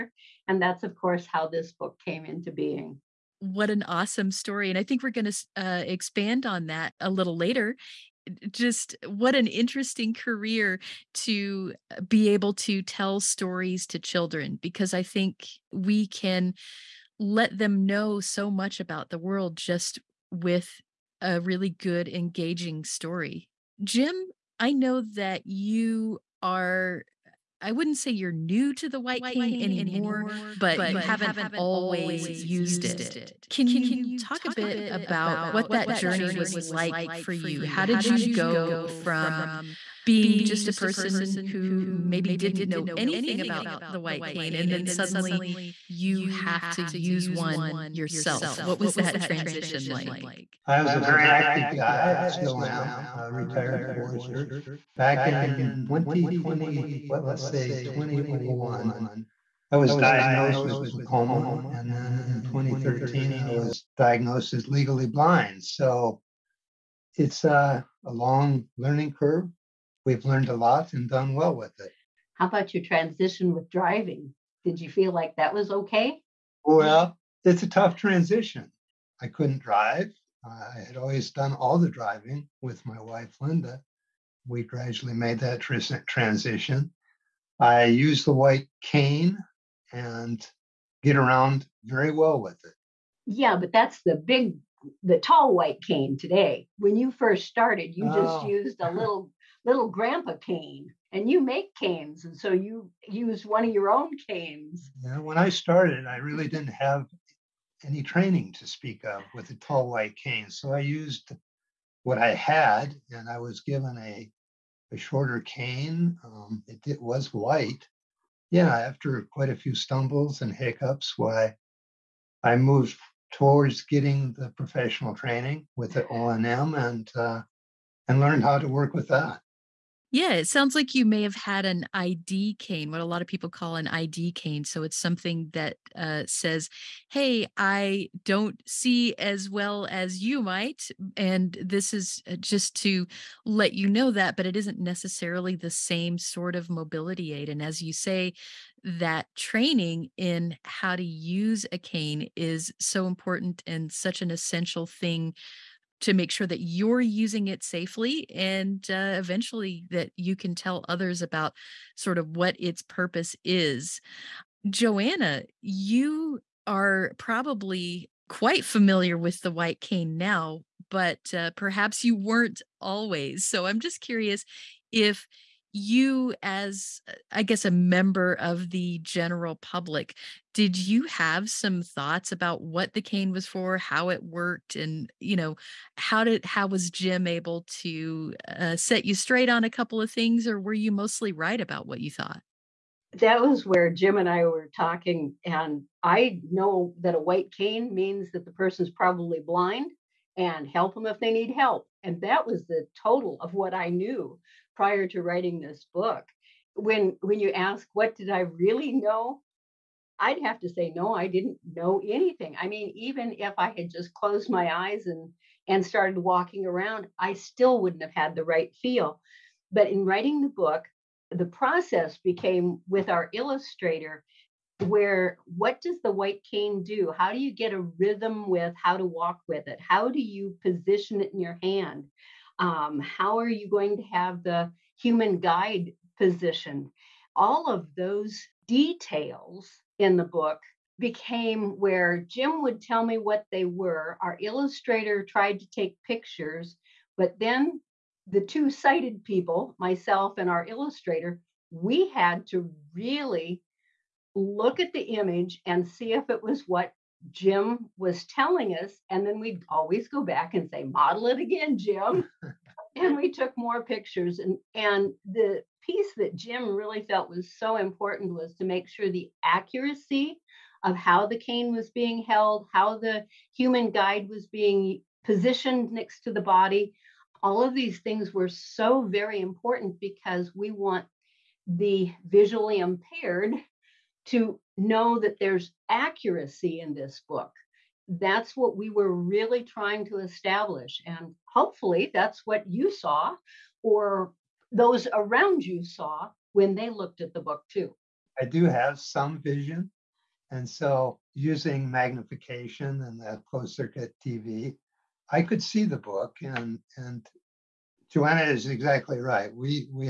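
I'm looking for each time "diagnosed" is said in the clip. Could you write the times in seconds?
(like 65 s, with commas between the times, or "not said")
59 s, 63 s.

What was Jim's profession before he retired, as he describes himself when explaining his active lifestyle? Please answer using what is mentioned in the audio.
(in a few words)
Forester.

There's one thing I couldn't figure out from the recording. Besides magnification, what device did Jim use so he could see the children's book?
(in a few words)
Closed circuit TV.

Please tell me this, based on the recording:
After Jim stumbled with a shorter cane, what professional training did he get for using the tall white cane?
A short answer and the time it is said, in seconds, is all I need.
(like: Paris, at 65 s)
O and M, at 126 s.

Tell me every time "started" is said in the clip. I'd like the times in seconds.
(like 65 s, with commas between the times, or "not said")
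97 s, 105 s, 215 s.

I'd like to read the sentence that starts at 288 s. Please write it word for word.
That's what we were really trying to establish.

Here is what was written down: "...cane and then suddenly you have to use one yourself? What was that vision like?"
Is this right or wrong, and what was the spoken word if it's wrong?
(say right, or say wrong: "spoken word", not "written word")
wrong: "transition", not "vision".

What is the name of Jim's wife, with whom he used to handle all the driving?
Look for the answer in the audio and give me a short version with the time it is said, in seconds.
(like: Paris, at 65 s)
Linda, at 83 s.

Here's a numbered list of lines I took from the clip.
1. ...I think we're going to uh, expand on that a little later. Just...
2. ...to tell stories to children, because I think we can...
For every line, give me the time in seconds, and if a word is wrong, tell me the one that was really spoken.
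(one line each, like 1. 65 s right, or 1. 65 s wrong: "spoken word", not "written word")
1. 4 s right
2. 12 s right.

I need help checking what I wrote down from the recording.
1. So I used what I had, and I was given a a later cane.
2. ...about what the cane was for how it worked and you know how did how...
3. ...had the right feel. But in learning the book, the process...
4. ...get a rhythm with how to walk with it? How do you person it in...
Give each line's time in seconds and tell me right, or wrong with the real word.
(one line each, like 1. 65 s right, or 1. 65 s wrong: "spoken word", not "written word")
1. 110 s wrong: "shorter", not "later"
2. 182 s right
3. 218 s wrong: "writing", not "learning"
4. 227 s wrong: "position", not "person".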